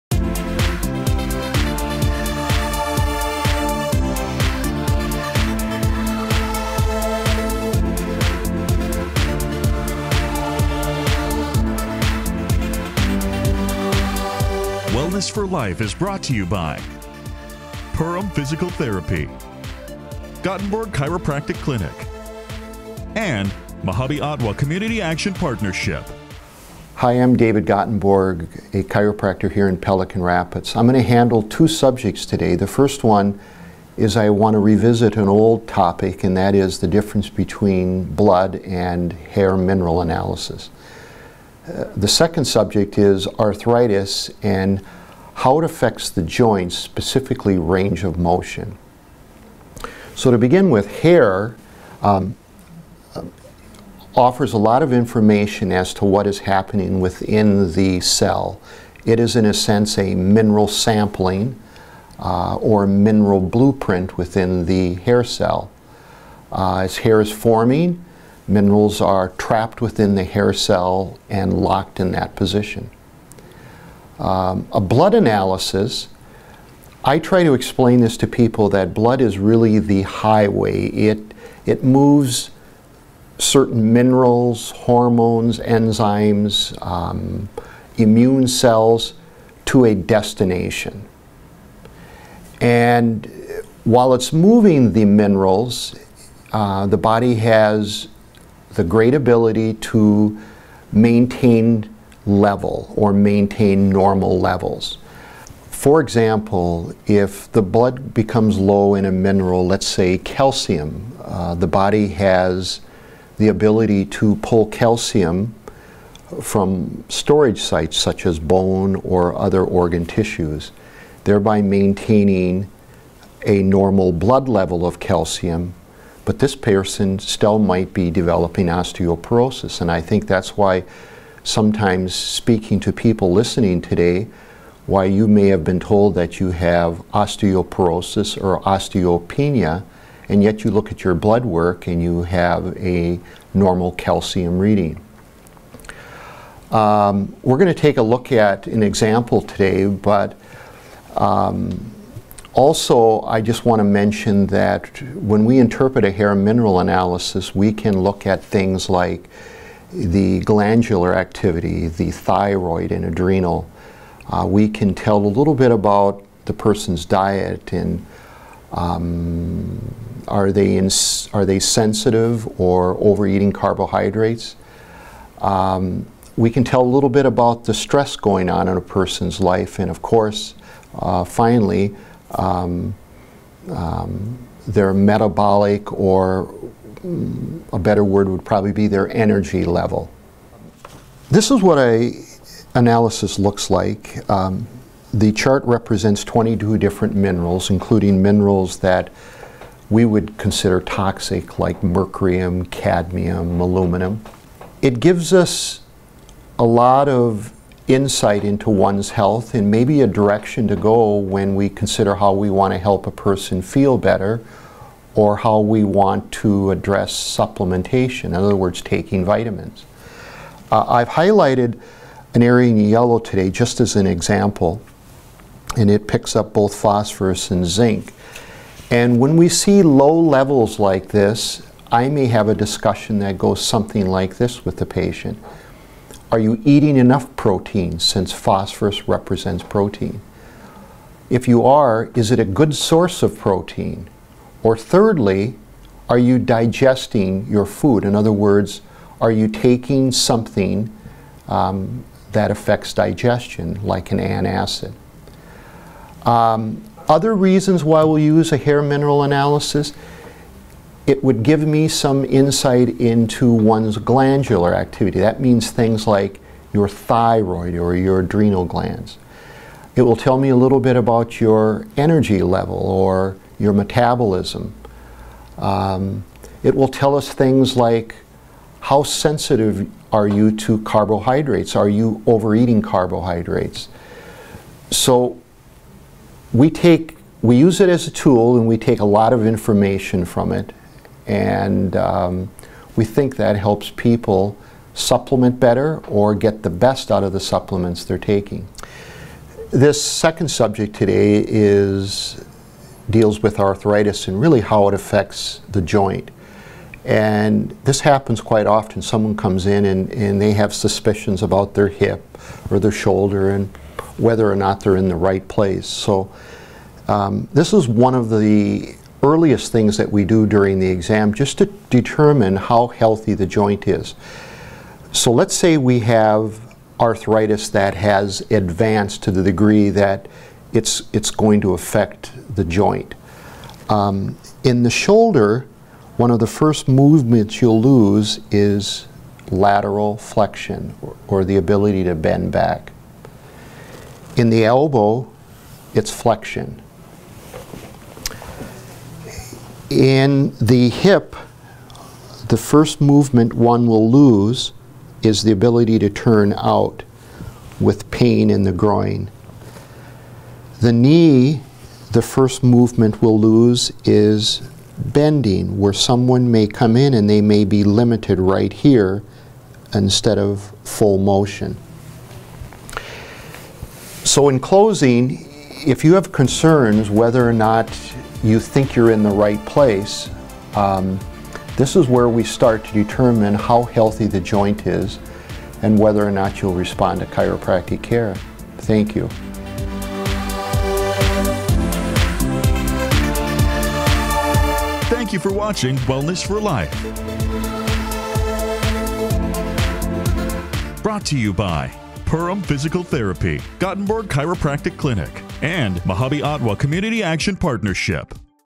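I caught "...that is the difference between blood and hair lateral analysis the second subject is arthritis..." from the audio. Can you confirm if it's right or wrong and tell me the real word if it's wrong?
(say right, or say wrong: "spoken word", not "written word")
wrong: "mineral", not "lateral".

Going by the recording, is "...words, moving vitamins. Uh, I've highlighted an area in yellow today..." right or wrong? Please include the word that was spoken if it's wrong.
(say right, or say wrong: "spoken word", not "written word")
wrong: "taking", not "moving".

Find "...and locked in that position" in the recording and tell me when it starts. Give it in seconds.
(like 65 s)
71 s.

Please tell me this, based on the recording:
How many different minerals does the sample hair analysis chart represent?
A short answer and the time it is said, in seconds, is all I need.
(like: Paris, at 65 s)
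22, at 196 s.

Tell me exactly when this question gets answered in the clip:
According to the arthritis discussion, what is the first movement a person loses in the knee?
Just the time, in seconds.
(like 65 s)
364 s.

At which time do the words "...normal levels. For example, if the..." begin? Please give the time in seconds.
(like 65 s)
103 s.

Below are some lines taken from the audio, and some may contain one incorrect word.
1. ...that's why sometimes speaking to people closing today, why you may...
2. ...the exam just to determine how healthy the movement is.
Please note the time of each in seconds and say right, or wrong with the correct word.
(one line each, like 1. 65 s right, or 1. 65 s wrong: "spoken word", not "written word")
1. 130 s wrong: "listening", not "closing"
2. 320 s wrong: "joint", not "movement".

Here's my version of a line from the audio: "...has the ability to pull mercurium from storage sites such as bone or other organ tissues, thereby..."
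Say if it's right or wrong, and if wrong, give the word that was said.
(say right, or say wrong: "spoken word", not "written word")
wrong: "calcium", not "mercurium".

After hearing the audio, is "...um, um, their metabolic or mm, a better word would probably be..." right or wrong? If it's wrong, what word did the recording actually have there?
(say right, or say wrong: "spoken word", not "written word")
right.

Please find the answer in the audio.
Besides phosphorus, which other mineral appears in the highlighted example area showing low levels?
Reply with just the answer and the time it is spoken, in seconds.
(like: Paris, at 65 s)
Zinc, at 227 s.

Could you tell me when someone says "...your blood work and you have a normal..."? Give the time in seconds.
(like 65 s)
141 s.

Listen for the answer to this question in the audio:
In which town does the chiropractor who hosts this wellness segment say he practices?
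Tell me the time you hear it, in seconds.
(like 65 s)
29 s.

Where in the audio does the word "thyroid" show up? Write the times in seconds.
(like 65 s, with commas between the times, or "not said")
162 s, 266 s.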